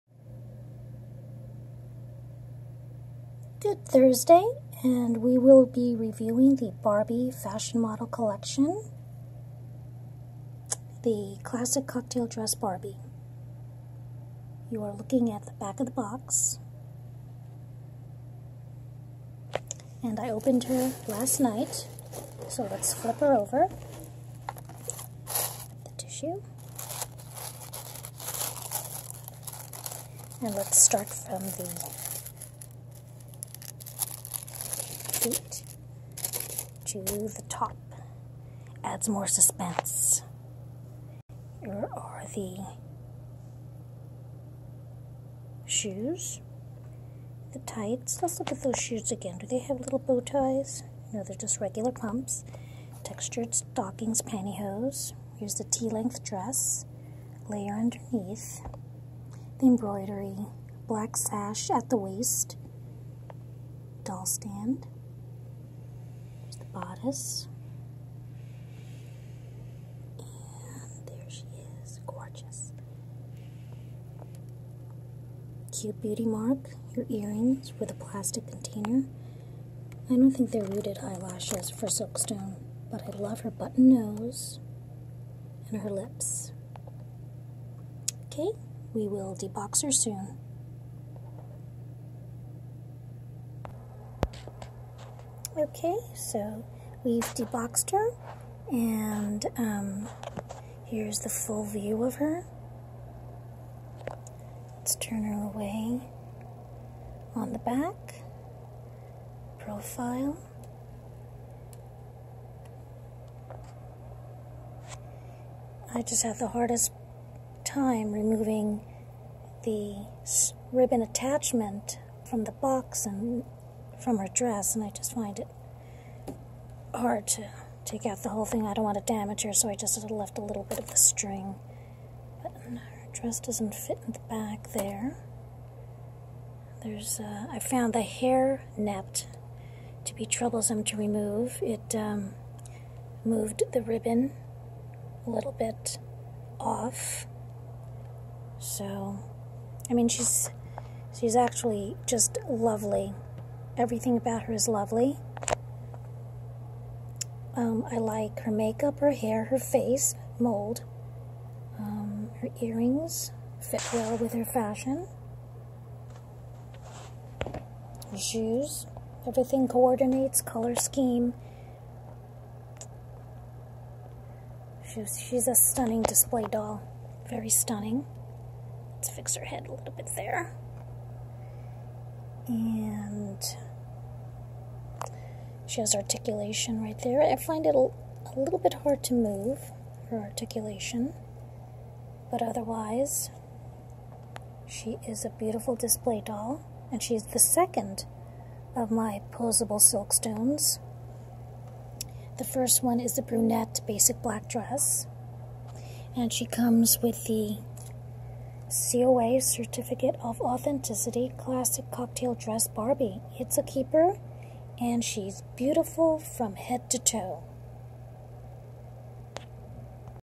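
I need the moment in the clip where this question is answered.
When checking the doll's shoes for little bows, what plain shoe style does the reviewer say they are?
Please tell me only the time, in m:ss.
0:51.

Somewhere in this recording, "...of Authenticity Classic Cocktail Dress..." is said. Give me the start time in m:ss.
3:30.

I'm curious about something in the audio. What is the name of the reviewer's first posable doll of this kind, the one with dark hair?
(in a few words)
Basic Black Dress.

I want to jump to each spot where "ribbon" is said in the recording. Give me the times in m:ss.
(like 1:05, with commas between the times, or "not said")
2:00, 2:23.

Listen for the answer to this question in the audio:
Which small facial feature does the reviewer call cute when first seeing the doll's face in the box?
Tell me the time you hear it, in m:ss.
1:16.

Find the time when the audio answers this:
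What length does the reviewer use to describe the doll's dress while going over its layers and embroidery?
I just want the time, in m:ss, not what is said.
0:55.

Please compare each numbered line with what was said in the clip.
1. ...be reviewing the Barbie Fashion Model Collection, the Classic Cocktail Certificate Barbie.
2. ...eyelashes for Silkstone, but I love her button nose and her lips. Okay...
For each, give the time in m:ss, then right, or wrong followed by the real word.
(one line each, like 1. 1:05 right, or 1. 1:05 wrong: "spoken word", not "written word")
1. 0:05 wrong: "Dress", not "Certificate"
2. 1:20 right.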